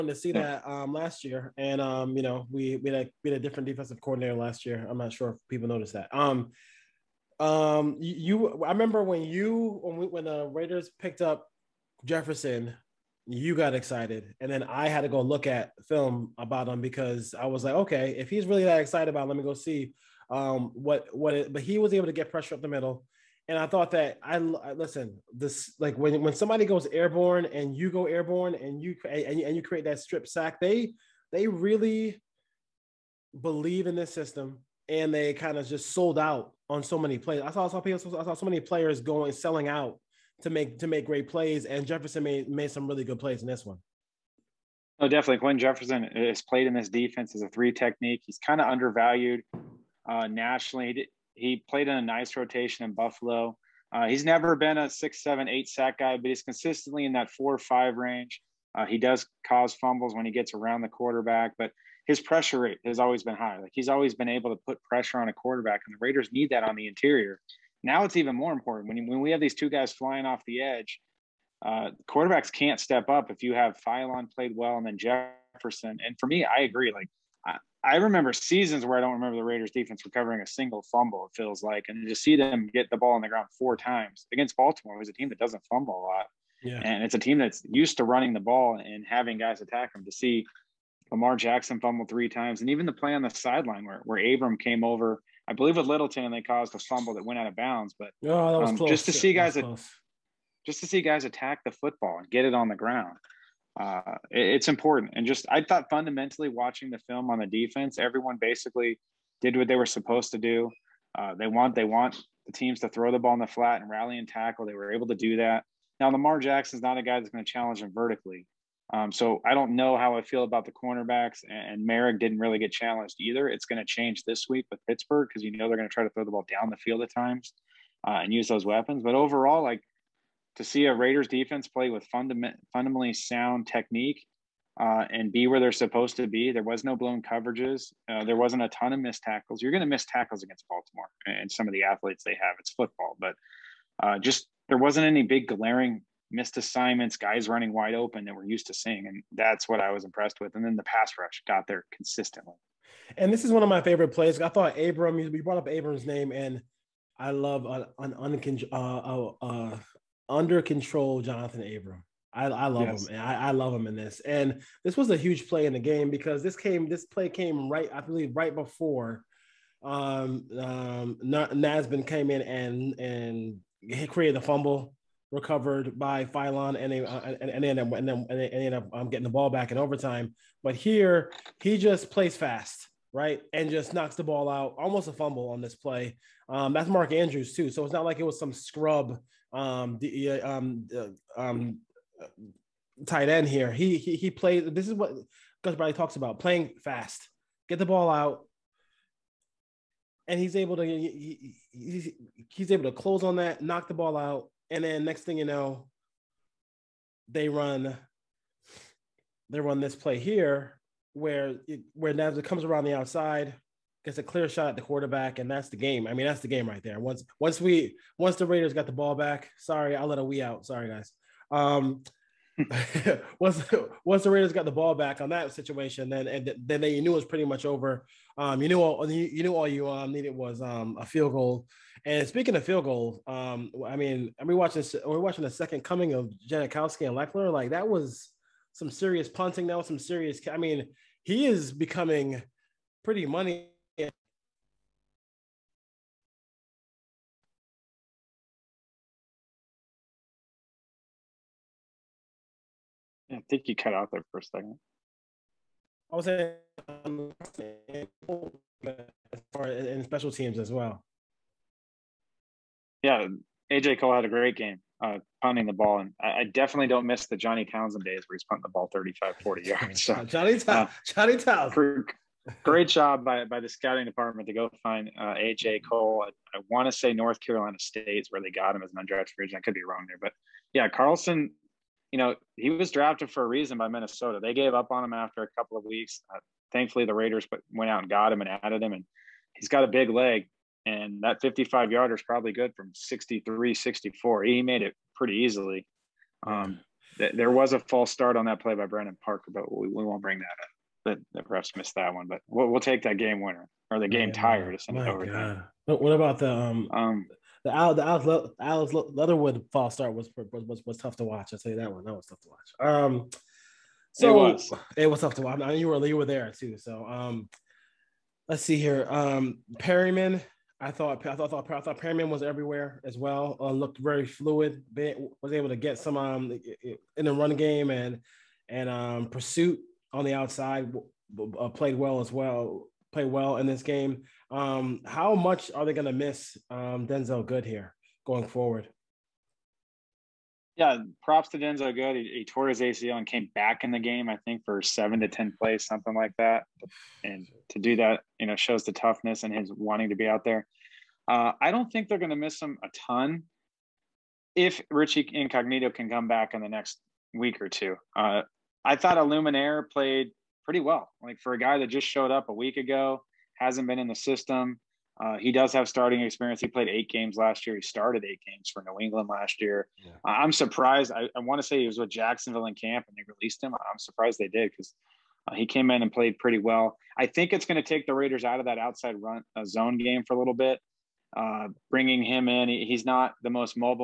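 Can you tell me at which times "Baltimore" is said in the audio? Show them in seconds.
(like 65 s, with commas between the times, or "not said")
84 s, 140 s.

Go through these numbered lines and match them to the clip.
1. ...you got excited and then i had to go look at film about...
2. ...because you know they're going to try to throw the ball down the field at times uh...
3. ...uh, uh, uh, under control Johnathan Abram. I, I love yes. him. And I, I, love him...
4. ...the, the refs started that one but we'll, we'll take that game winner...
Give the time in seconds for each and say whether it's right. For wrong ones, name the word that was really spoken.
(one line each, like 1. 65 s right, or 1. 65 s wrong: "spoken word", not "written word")
1. 13 s right
2. 125 s right
3. 158 s right
4. 301 s wrong: "missed", not "started".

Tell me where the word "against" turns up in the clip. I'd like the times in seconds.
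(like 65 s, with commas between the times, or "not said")
84 s, 140 s.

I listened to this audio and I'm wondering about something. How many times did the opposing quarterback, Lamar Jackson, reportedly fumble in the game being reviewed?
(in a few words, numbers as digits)
3.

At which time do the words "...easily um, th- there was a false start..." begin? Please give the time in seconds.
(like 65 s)
295 s.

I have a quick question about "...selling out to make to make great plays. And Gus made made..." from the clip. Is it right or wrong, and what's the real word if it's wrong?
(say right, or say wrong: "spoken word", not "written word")
wrong: "Jefferson", not "Gus".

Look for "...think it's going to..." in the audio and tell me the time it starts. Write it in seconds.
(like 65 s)
377 s.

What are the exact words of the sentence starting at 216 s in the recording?
I mean, that's the game right there.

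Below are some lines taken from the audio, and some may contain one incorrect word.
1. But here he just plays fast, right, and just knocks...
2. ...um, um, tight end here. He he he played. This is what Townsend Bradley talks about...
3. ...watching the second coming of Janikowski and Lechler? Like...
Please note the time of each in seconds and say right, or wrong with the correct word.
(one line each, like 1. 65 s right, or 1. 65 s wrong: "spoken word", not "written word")
1. 180 s right
2. 190 s wrong: "Gus", not "Townsend"
3. 235 s right.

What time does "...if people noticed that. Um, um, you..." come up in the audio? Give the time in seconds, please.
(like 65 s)
5 s.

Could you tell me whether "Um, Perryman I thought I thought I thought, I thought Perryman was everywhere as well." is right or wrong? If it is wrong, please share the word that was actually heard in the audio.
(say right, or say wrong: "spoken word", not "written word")
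right.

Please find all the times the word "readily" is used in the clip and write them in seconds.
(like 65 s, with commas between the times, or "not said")
not said.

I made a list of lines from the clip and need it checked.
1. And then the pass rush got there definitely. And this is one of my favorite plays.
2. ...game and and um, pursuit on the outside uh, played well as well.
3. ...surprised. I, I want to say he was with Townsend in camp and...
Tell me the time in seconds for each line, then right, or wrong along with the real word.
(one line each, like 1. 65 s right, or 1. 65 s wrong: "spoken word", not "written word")
1. 150 s wrong: "consistently", not "definitely"
2. 327 s right
3. 370 s wrong: "Jacksonville", not "Townsend".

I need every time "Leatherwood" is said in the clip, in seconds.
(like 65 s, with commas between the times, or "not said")
309 s.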